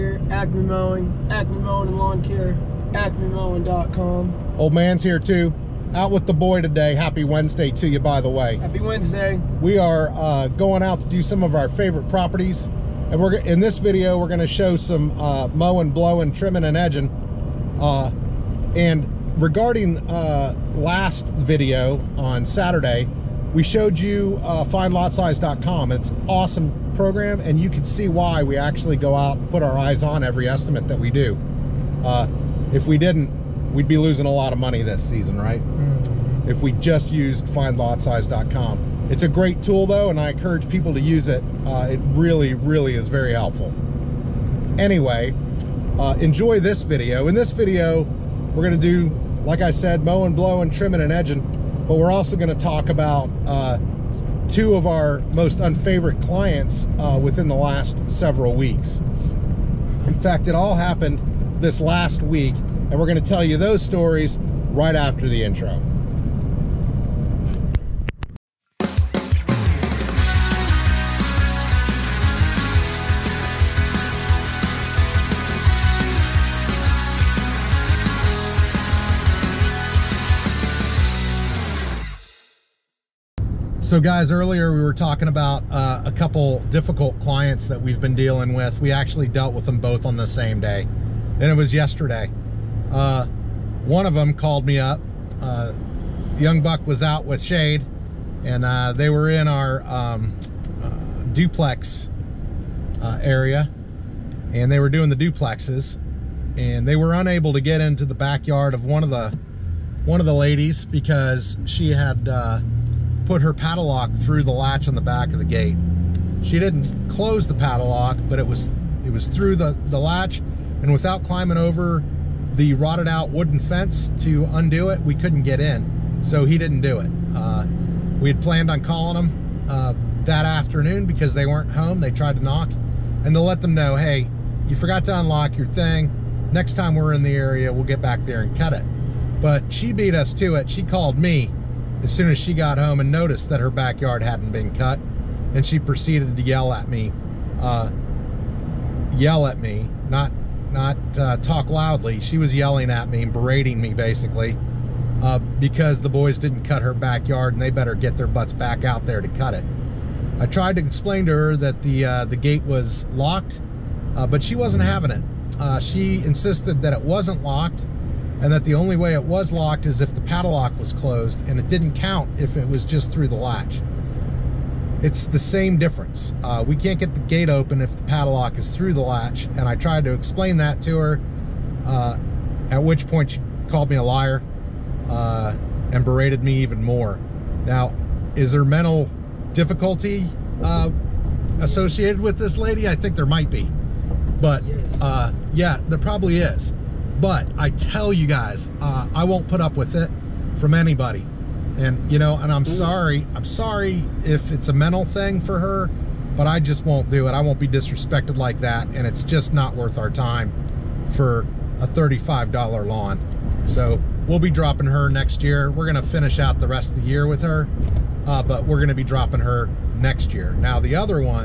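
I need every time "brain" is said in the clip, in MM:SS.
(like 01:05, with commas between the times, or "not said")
not said.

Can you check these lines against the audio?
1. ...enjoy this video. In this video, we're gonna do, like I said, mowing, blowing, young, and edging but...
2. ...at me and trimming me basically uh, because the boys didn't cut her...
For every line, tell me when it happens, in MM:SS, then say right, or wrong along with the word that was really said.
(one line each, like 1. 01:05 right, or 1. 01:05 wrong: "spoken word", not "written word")
1. 00:46 wrong: "trimming", not "young"
2. 02:32 wrong: "berating", not "trimming".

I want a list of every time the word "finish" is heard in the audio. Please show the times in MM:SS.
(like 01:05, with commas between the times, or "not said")
03:36.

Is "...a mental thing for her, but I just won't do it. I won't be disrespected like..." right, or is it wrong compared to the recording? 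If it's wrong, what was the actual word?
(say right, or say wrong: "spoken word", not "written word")
right.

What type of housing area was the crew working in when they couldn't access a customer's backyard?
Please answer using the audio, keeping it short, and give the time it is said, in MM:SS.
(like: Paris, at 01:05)
Duplex, at 01:41.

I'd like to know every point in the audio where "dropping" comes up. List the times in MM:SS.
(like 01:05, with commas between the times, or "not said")
03:34, 03:39.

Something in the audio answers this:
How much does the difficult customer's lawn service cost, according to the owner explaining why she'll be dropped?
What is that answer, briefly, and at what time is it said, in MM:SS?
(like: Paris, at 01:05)
$35, at 03:31.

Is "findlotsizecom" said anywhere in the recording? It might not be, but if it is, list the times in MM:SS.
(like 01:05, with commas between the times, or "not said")
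00:24, 00:37.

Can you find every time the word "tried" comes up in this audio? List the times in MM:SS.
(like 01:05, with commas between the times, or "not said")
02:12, 02:40, 02:59.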